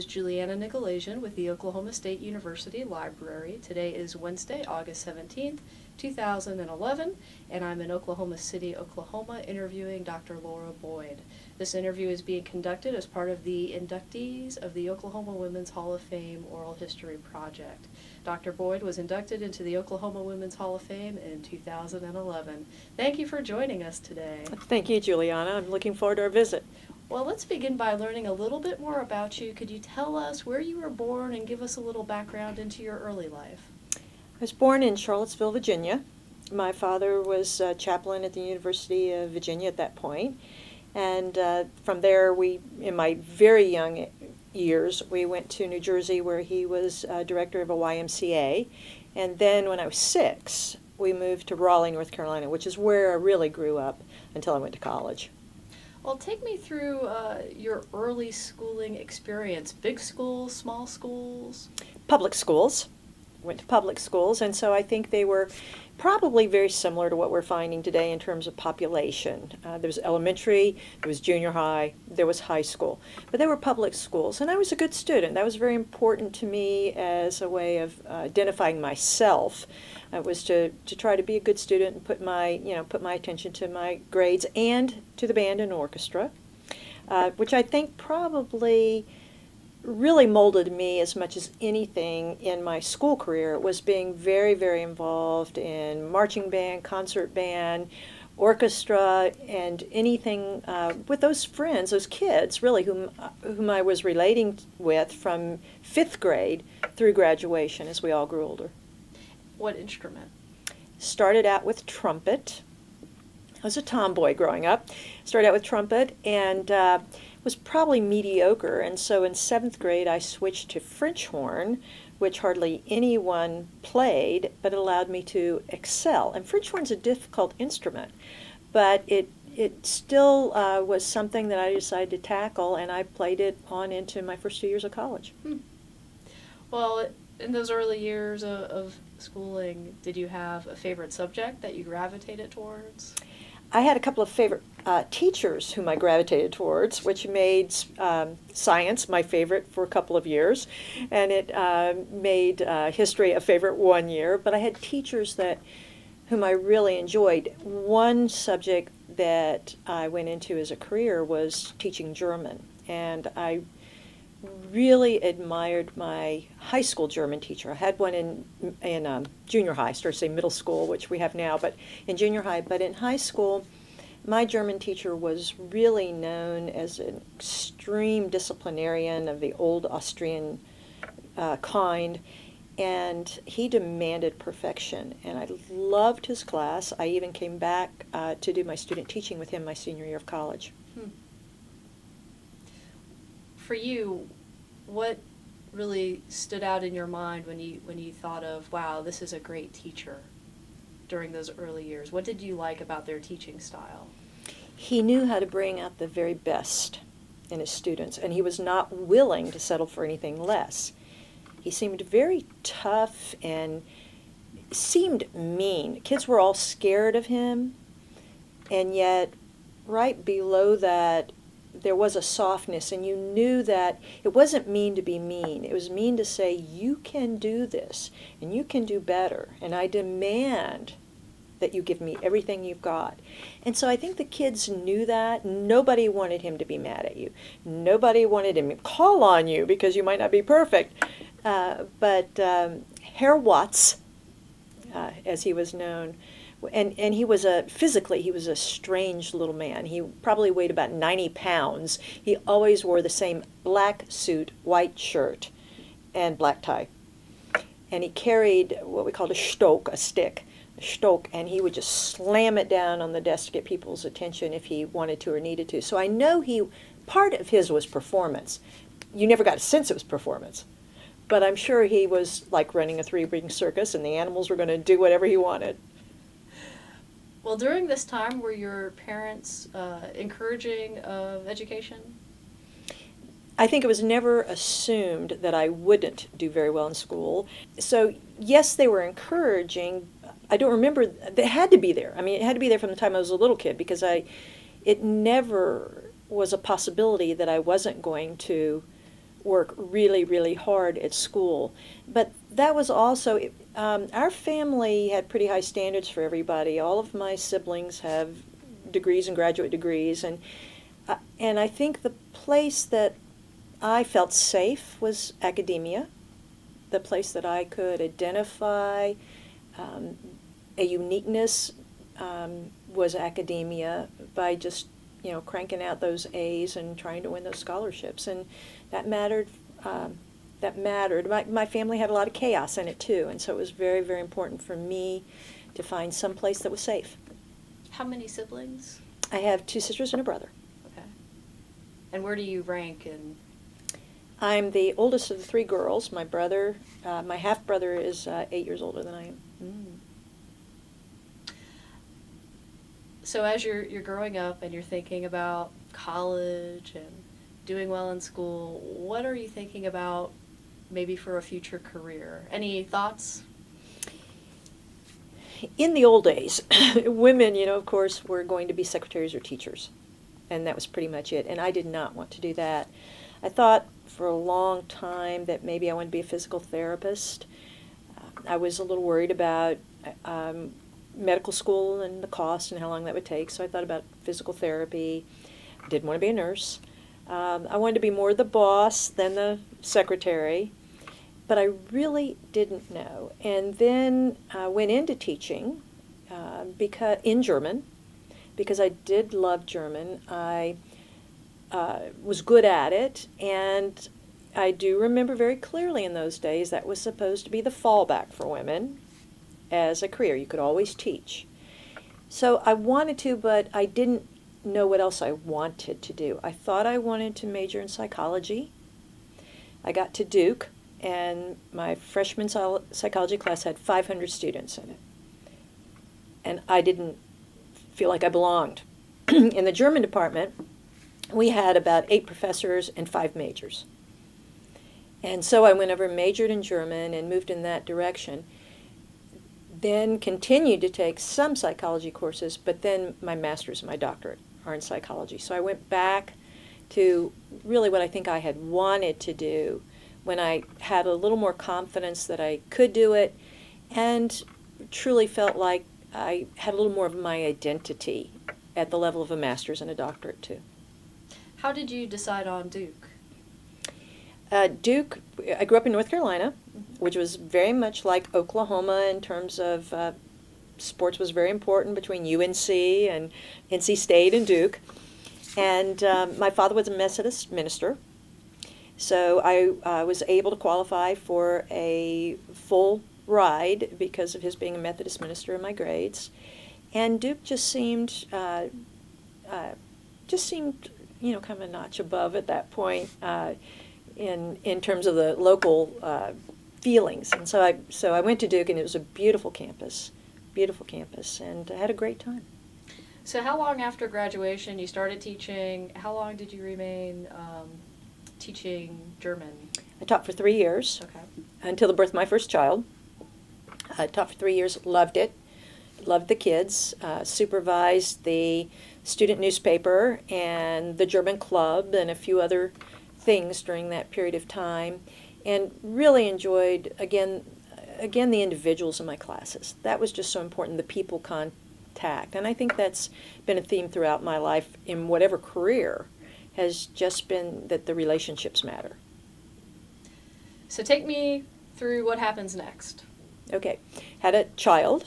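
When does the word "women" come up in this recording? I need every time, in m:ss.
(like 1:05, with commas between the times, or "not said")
0:15, 0:20, 6:07, 6:48.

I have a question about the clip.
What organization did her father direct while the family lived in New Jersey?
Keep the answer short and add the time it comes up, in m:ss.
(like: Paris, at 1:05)
YMCA, at 0:47.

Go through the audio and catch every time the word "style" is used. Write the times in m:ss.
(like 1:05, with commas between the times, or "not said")
3:23.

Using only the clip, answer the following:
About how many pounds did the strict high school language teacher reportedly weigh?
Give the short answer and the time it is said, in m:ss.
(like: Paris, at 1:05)
90, at 4:10.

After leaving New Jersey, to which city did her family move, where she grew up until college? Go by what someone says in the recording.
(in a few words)
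Raleigh, North Carolina.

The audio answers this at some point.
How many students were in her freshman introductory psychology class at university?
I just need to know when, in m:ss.
7:03.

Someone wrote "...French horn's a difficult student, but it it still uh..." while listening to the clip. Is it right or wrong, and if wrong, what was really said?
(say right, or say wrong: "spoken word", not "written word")
wrong: "instrument", not "student".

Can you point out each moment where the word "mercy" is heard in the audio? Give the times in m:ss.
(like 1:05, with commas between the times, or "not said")
not said.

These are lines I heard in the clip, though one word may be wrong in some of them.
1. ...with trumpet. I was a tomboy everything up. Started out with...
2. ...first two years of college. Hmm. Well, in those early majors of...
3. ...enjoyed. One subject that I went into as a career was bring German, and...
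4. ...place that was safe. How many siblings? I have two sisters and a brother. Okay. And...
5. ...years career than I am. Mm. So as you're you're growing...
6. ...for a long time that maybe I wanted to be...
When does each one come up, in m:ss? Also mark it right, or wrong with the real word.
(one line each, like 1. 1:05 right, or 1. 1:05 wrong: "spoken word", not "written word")
1. 1:51 wrong: "growing", not "everything"
2. 2:14 wrong: "years", not "majors"
3. 2:36 wrong: "teaching", not "bring"
4. 5:36 right
5. 5:48 wrong: "older", not "career"
6. 6:14 right.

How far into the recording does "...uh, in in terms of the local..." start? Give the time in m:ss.
8:13.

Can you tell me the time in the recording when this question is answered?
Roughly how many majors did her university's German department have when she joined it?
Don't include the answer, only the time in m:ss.
7:13.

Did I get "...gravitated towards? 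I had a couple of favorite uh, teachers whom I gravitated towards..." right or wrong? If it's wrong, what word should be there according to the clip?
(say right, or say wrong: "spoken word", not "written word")
right.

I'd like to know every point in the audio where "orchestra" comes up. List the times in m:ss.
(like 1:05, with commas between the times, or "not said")
1:25, 1:38.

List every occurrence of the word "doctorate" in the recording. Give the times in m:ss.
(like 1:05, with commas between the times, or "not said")
7:23, 7:39.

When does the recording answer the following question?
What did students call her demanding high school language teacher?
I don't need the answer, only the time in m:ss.
4:03.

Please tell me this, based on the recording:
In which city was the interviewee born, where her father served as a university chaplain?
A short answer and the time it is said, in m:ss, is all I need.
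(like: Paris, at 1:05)
Charlottesville, Virginia, at 0:34.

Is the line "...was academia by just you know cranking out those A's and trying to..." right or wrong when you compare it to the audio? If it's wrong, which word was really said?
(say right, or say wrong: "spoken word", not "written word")
right.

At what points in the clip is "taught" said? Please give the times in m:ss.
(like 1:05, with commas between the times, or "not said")
8:30, 8:34.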